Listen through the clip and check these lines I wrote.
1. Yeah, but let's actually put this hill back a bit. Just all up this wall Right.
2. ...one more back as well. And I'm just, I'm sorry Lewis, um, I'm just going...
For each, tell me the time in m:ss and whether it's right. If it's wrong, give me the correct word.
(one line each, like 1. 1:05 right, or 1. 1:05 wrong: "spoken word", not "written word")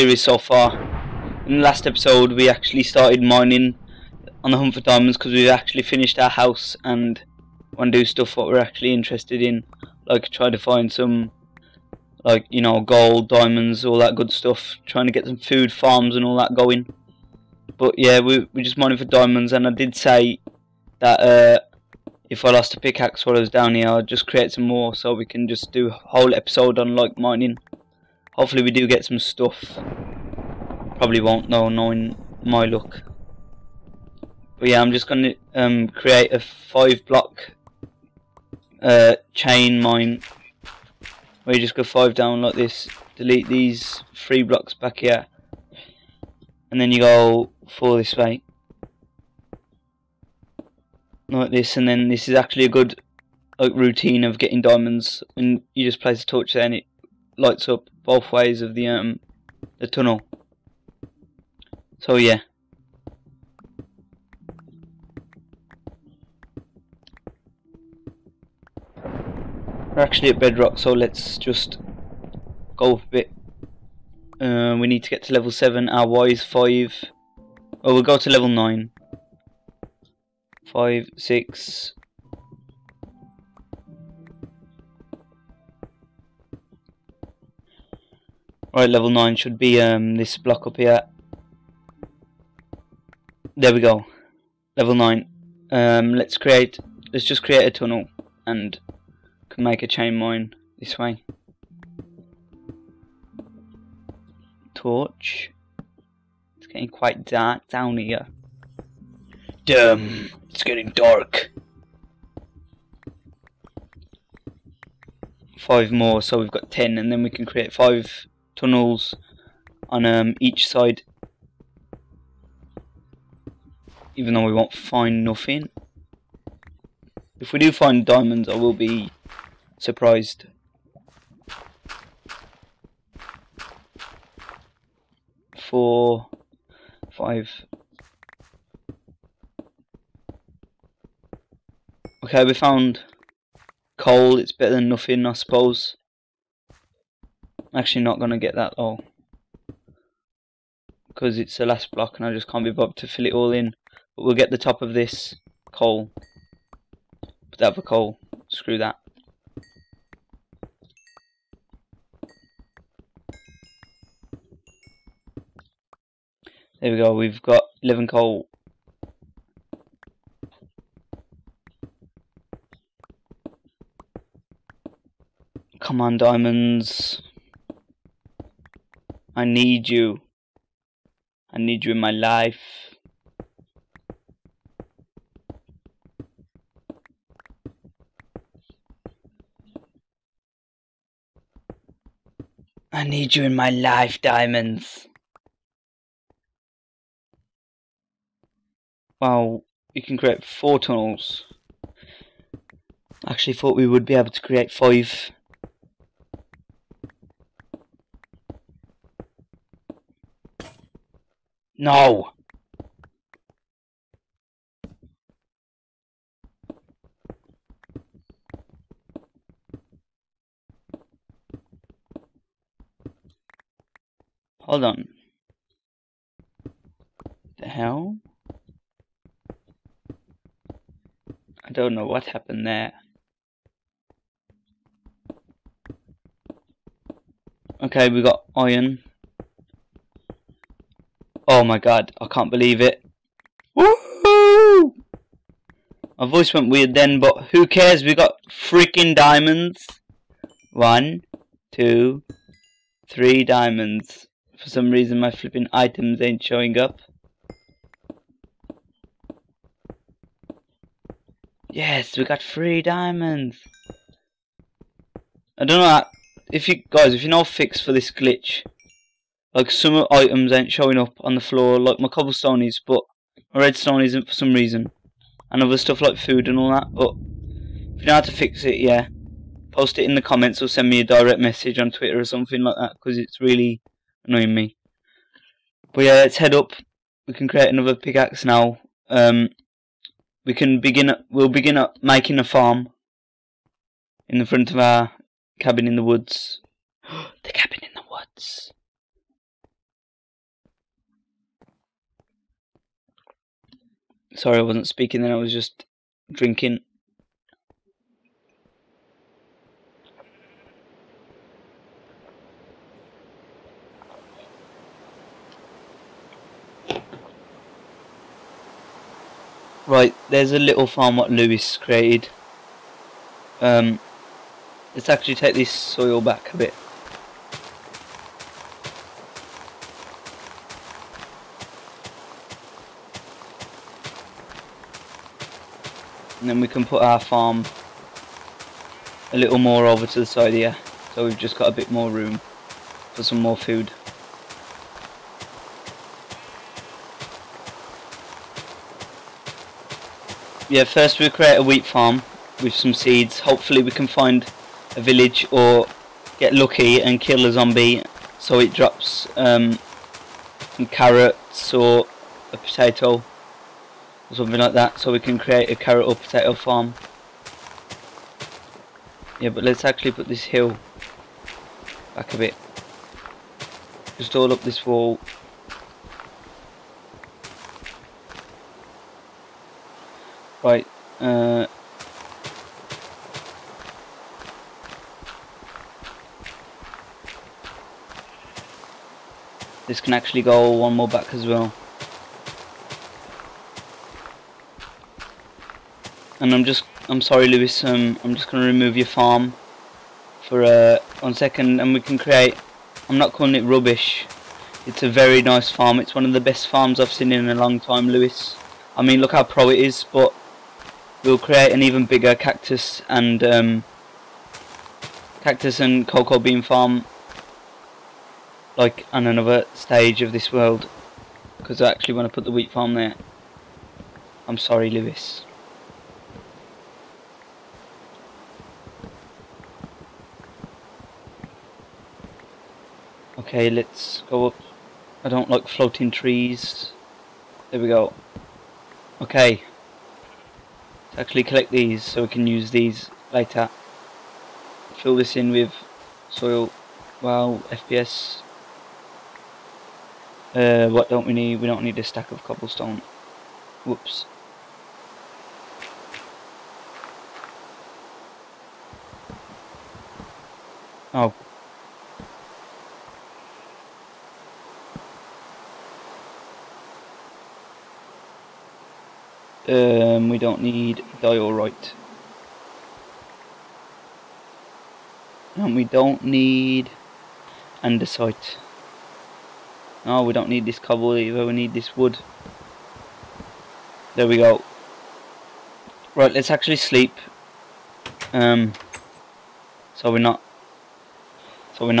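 1. 6:09 right
2. 6:30 right.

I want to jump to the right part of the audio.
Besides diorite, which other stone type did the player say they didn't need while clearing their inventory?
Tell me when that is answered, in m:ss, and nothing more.
7:57.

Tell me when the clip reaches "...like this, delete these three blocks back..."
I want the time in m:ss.
0:42.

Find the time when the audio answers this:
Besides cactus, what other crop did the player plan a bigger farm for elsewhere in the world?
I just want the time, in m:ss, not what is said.
6:56.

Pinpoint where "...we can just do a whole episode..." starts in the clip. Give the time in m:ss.
0:25.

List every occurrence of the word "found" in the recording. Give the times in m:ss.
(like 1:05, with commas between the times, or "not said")
2:22.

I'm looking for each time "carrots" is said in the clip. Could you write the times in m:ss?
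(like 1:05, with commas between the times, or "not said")
6:00, 6:05.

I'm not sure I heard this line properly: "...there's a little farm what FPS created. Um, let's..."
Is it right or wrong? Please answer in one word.
wrong.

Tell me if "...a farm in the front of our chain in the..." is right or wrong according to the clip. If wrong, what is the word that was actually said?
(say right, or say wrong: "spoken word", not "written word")
wrong: "cabin", not "chain".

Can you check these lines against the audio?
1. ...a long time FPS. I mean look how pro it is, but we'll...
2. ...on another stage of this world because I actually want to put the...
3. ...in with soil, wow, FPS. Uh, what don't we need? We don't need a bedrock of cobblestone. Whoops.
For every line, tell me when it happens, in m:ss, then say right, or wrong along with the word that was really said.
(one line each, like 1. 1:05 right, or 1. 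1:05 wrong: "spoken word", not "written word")
1. 6:47 wrong: "Lewis", not "FPS"
2. 6:59 right
3. 7:25 wrong: "stack", not "bedrock".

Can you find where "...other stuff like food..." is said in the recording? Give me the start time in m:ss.
4:35.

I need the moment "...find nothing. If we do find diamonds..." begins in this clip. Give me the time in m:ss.
2:04.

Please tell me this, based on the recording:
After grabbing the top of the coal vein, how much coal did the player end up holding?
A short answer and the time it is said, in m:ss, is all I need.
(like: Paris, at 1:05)
11, at 2:47.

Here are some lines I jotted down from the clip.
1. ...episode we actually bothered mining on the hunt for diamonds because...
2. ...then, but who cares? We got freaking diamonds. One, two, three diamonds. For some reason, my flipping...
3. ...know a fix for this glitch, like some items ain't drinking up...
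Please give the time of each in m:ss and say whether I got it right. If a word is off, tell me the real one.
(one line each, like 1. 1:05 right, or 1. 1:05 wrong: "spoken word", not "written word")
1. 0:01 wrong: "started", not "bothered"
2. 4:06 right
3. 4:27 wrong: "showing", not "drinking".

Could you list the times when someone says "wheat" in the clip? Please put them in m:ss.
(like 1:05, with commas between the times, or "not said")
5:51, 7:02.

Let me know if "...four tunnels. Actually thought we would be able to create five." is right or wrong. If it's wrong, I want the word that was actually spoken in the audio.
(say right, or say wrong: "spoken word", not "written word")
right.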